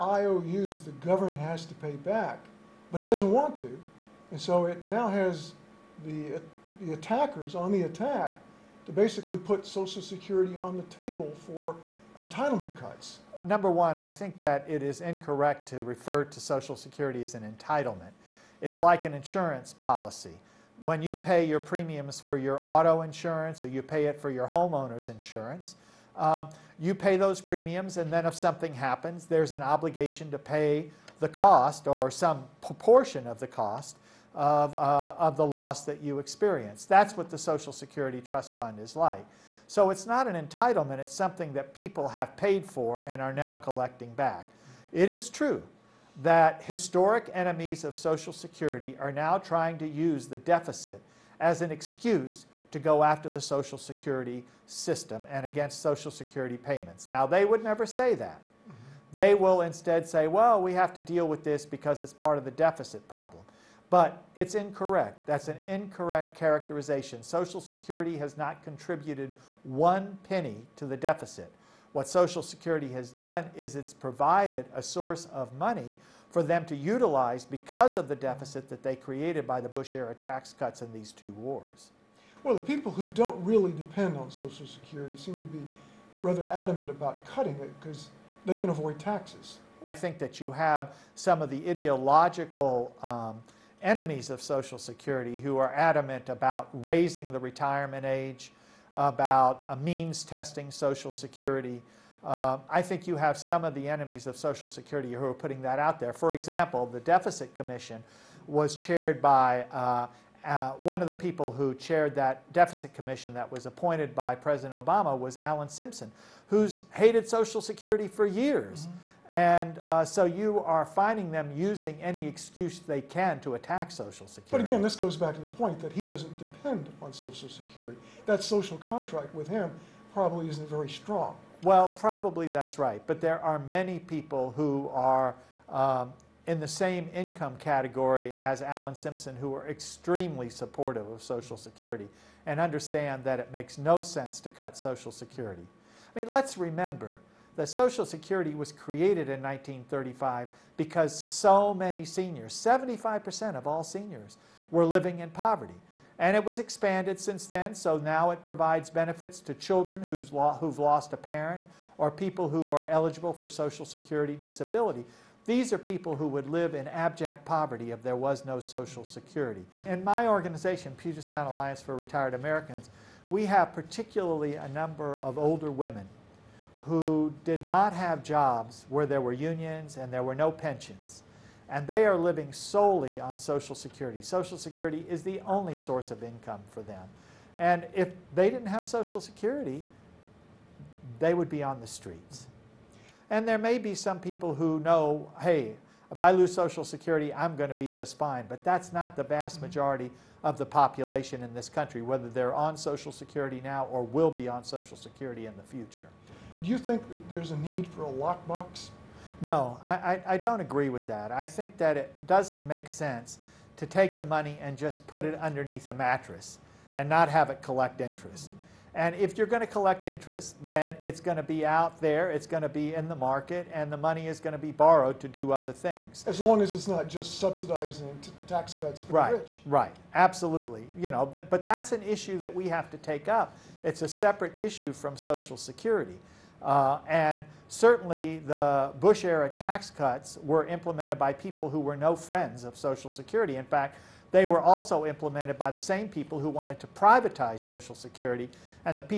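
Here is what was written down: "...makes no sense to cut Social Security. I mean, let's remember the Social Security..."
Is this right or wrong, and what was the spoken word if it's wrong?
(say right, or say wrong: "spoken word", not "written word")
right.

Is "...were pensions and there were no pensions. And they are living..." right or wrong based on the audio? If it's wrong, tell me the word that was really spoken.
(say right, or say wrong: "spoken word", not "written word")
wrong: "unions", not "pensions".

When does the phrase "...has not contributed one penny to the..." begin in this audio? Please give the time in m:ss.
1:08.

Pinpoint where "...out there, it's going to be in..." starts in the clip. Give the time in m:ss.
3:41.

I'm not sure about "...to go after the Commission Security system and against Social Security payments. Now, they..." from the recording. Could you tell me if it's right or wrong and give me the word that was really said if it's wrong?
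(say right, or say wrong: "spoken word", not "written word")
wrong: "Social", not "Commission".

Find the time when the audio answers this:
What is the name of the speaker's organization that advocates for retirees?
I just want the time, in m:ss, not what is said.
2:50.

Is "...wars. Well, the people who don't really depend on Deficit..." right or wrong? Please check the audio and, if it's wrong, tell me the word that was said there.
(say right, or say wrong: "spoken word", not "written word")
wrong: "Social", not "Deficit".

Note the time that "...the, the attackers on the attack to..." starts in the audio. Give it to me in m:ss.
0:06.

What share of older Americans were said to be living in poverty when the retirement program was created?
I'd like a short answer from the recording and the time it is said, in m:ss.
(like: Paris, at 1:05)
75%, at 2:32.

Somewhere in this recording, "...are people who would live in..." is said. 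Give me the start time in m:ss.
2:45.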